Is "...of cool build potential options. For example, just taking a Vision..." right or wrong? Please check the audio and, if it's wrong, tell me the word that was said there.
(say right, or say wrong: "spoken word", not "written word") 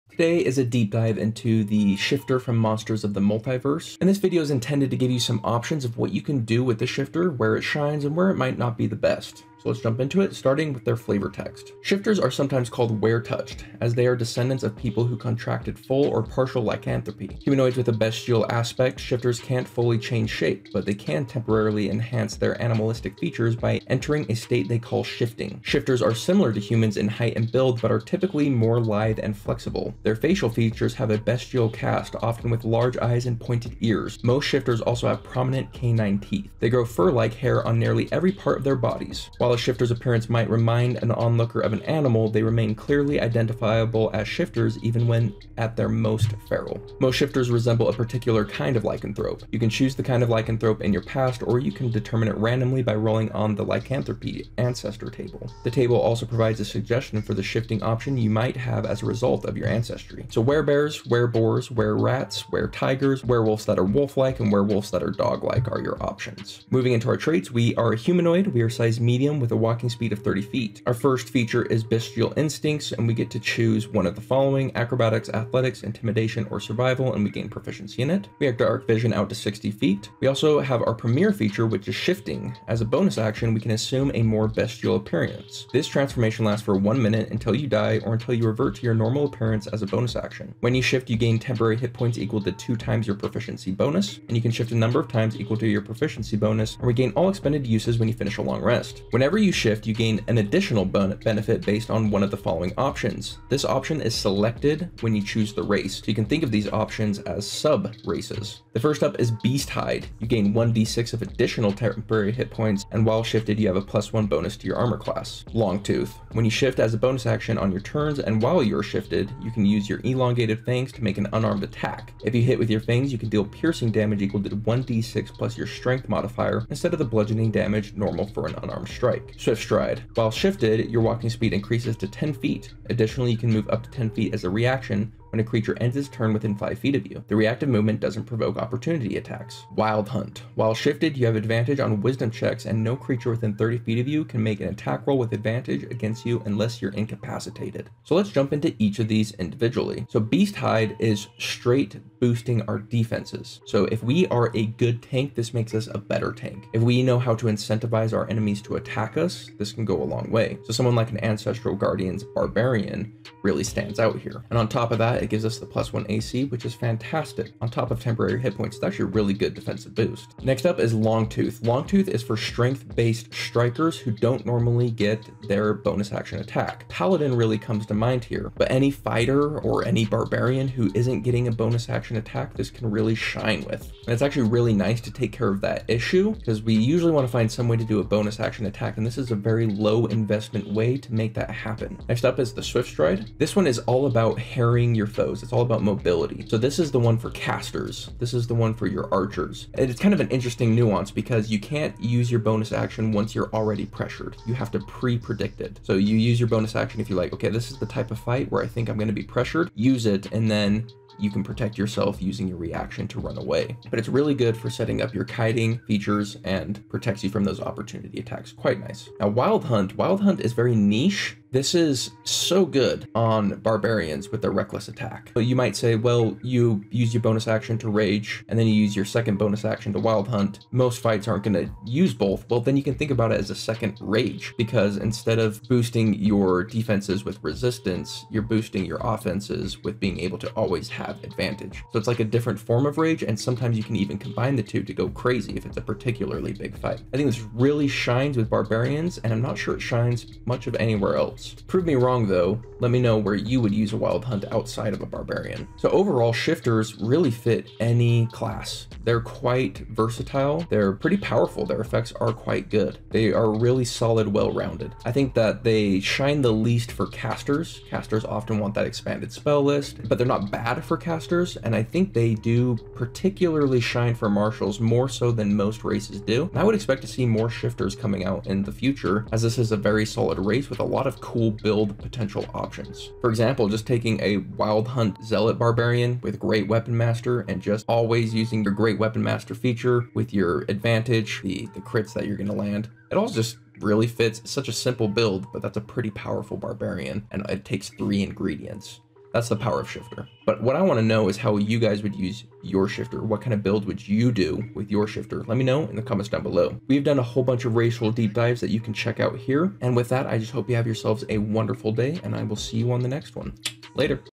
wrong: "Wild", not "Vision".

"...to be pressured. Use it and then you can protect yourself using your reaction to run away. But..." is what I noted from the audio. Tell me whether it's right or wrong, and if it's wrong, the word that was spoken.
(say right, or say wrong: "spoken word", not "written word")
right.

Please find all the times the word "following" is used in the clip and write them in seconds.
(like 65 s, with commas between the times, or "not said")
74 s, 102 s.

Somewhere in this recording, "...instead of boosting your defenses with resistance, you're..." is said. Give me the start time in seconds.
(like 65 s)
234 s.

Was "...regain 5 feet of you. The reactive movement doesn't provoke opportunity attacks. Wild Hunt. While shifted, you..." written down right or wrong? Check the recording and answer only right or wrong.
wrong.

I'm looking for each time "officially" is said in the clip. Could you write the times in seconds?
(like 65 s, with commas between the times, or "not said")
not said.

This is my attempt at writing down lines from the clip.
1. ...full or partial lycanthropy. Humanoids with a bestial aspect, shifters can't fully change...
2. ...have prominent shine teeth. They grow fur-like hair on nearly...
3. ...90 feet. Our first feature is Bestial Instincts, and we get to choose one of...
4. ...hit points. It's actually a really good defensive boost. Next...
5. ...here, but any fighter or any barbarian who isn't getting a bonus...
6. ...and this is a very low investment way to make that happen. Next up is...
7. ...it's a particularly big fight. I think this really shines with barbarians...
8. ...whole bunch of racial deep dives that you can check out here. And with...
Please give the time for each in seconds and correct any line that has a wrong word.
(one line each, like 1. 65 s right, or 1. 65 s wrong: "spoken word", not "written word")
1. 15 s right
2. 35 s wrong: "canine", not "shine"
3. 70 s wrong: "30", not "90"
4. 168 s right
5. 178 s right
6. 188 s right
7. 245 s right
8. 307 s right.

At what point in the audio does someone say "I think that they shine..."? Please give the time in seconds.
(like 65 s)
265 s.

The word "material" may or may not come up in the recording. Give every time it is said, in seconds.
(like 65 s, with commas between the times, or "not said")
not said.